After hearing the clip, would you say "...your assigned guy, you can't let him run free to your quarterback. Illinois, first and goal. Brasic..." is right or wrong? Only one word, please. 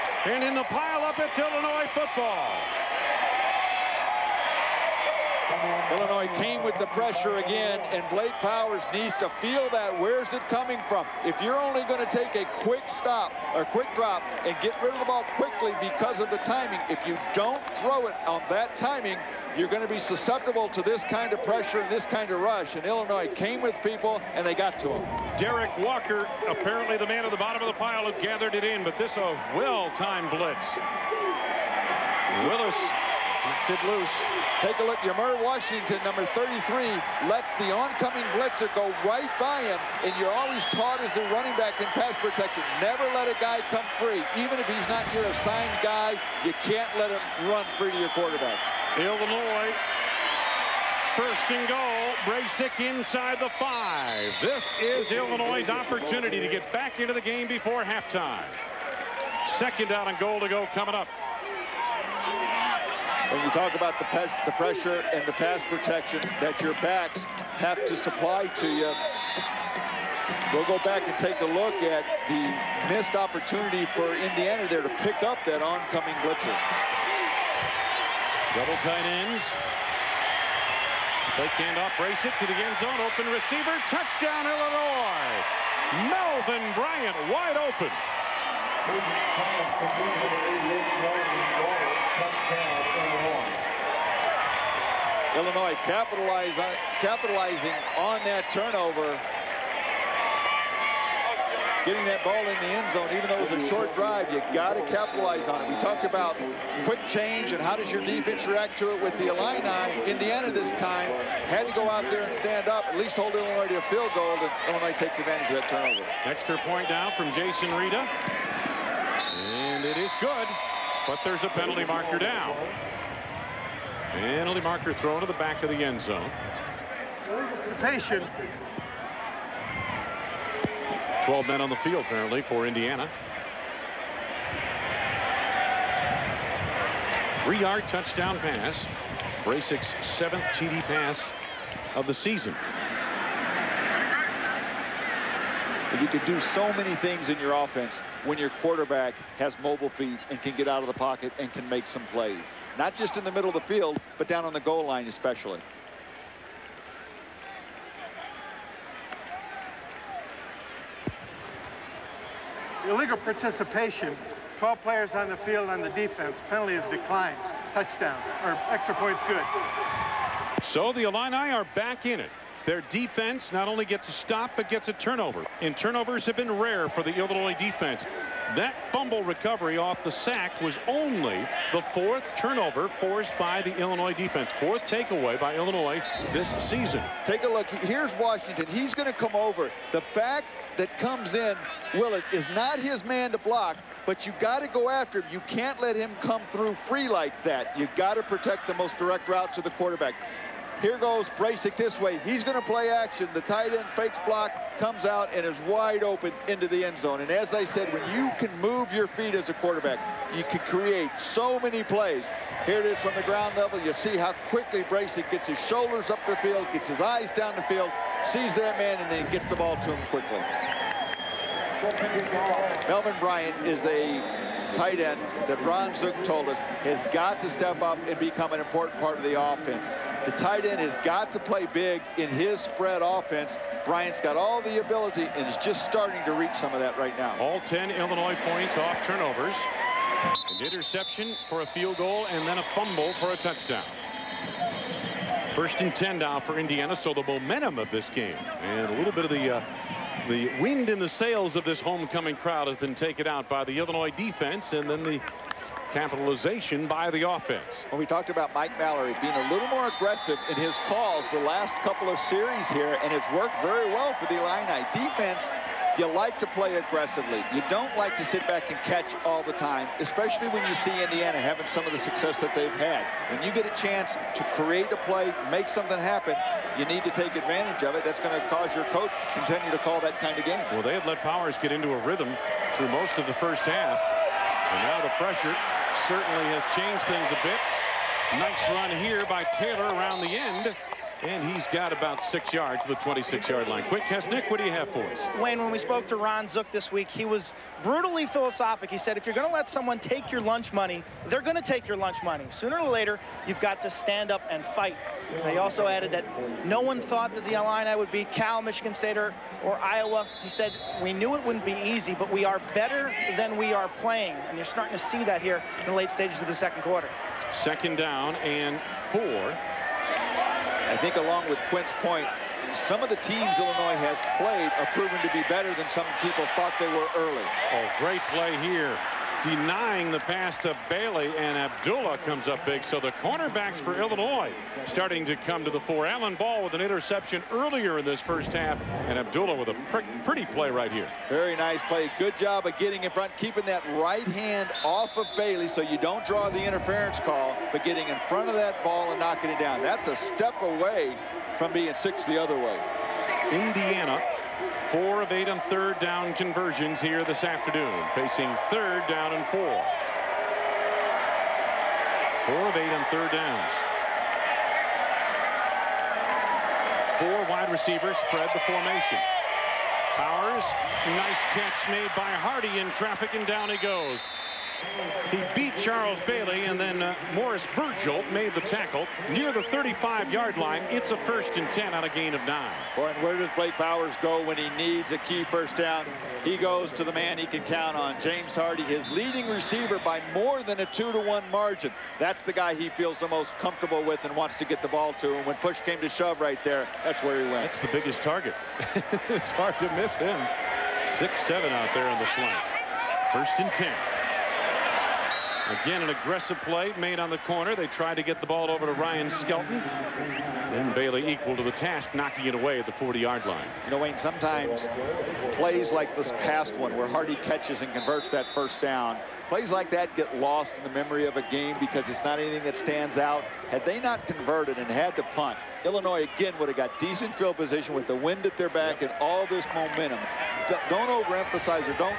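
right.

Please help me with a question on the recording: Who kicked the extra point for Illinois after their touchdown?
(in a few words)
Jason Reda.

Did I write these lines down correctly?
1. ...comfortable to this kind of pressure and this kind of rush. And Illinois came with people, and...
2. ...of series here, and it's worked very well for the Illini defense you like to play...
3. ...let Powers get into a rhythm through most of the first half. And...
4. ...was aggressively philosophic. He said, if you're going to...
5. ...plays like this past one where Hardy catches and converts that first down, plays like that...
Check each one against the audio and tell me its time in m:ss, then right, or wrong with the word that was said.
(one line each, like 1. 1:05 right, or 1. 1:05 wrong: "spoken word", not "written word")
1. 0:19 wrong: "susceptible", not "comfortable"
2. 4:22 right
3. 4:41 right
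4. 4:57 wrong: "brutally", not "aggressively"
5. 6:55 right.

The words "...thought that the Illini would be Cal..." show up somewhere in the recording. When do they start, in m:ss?
5:06.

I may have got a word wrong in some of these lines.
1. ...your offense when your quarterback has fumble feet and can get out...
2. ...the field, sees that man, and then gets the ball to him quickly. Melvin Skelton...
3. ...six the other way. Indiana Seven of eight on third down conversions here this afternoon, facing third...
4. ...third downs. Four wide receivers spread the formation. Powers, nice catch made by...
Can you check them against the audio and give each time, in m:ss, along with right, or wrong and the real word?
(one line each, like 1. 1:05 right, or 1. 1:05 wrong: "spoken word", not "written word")
1. 2:27 wrong: "mobile", not "fumble"
2. 3:37 wrong: "Bryant", not "Skelton"
3. 5:51 wrong: "Four", not "Seven"
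4. 6:03 right.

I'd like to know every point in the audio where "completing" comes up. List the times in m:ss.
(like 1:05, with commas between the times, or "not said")
not said.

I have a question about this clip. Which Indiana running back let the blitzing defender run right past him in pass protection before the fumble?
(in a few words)
Yamar Washington.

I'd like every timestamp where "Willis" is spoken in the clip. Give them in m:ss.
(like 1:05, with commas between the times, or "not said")
0:32, 3:11.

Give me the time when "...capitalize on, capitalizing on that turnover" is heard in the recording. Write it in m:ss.
1:35.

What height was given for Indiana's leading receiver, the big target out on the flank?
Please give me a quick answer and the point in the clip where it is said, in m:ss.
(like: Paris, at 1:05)
6-7, at 6:41.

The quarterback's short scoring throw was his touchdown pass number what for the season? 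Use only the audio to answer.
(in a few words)
7th.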